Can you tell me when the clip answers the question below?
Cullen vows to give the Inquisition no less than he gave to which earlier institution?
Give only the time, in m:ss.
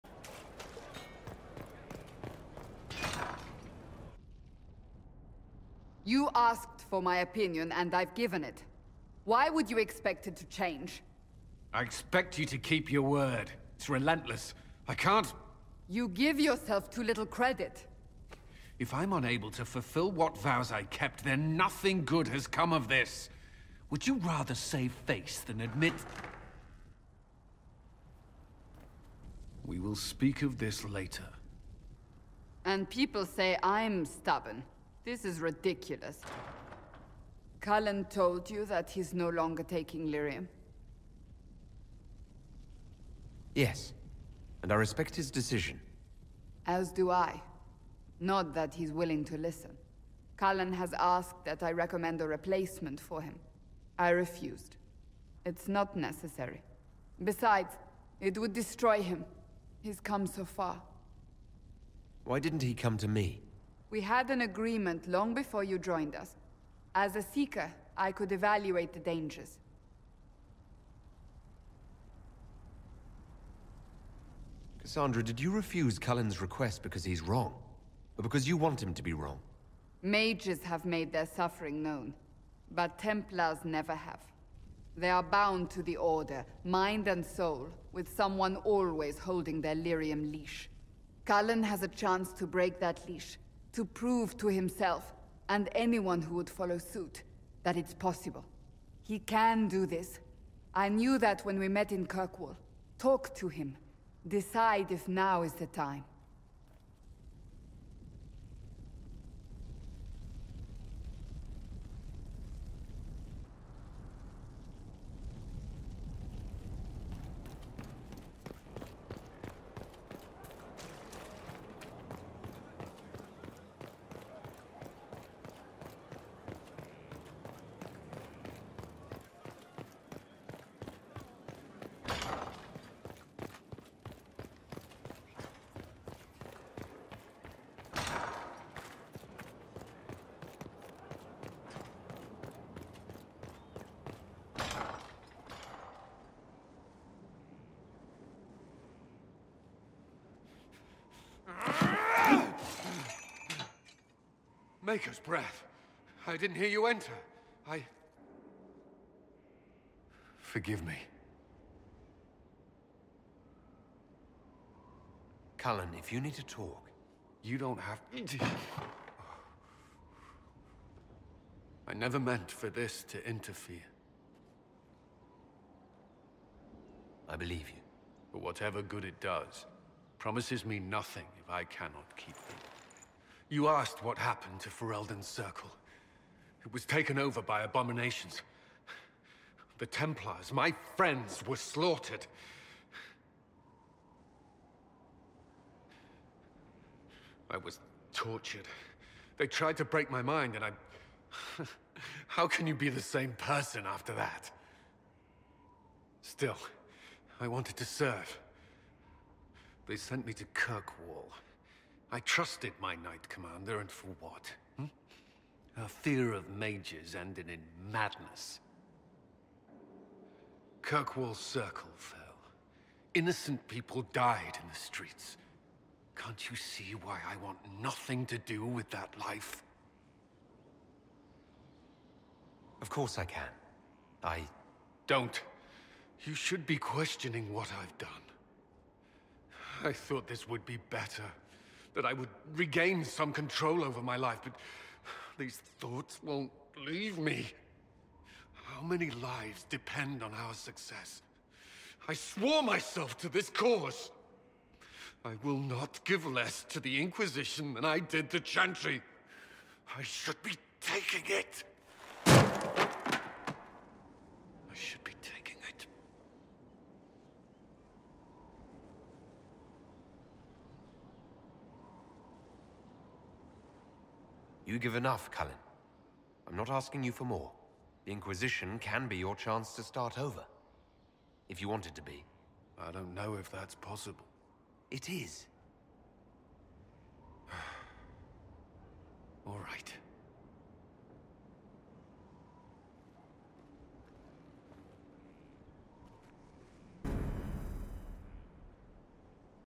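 4:18.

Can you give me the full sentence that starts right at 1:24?
They are bound to the Order, mind and soul, with someone always holding their lyrium leash.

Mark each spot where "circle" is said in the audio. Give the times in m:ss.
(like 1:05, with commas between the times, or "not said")
3:05, 3:41.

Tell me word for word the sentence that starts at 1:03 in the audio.
We had an agreement long before you joined us.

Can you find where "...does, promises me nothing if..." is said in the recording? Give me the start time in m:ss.
2:59.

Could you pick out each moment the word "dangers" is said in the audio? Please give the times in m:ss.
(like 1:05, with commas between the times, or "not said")
1:09.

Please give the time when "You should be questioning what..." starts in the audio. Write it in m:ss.
3:56.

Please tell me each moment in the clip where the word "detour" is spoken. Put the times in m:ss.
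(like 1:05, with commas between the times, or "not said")
not said.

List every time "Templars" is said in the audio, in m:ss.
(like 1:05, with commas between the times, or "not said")
1:22, 3:09.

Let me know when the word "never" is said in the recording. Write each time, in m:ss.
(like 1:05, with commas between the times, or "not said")
1:23, 2:51.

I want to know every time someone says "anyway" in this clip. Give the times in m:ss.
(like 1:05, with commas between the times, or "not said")
not said.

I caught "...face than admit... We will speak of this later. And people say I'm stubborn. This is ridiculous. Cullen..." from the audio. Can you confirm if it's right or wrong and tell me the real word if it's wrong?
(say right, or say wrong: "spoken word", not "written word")
right.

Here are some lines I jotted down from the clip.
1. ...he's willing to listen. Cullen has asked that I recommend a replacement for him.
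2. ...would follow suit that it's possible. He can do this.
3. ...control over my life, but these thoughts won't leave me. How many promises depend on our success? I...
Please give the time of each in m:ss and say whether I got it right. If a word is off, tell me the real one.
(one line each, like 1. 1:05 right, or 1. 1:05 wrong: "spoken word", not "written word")
1. 0:48 right
2. 1:36 right
3. 4:03 wrong: "lives", not "promises".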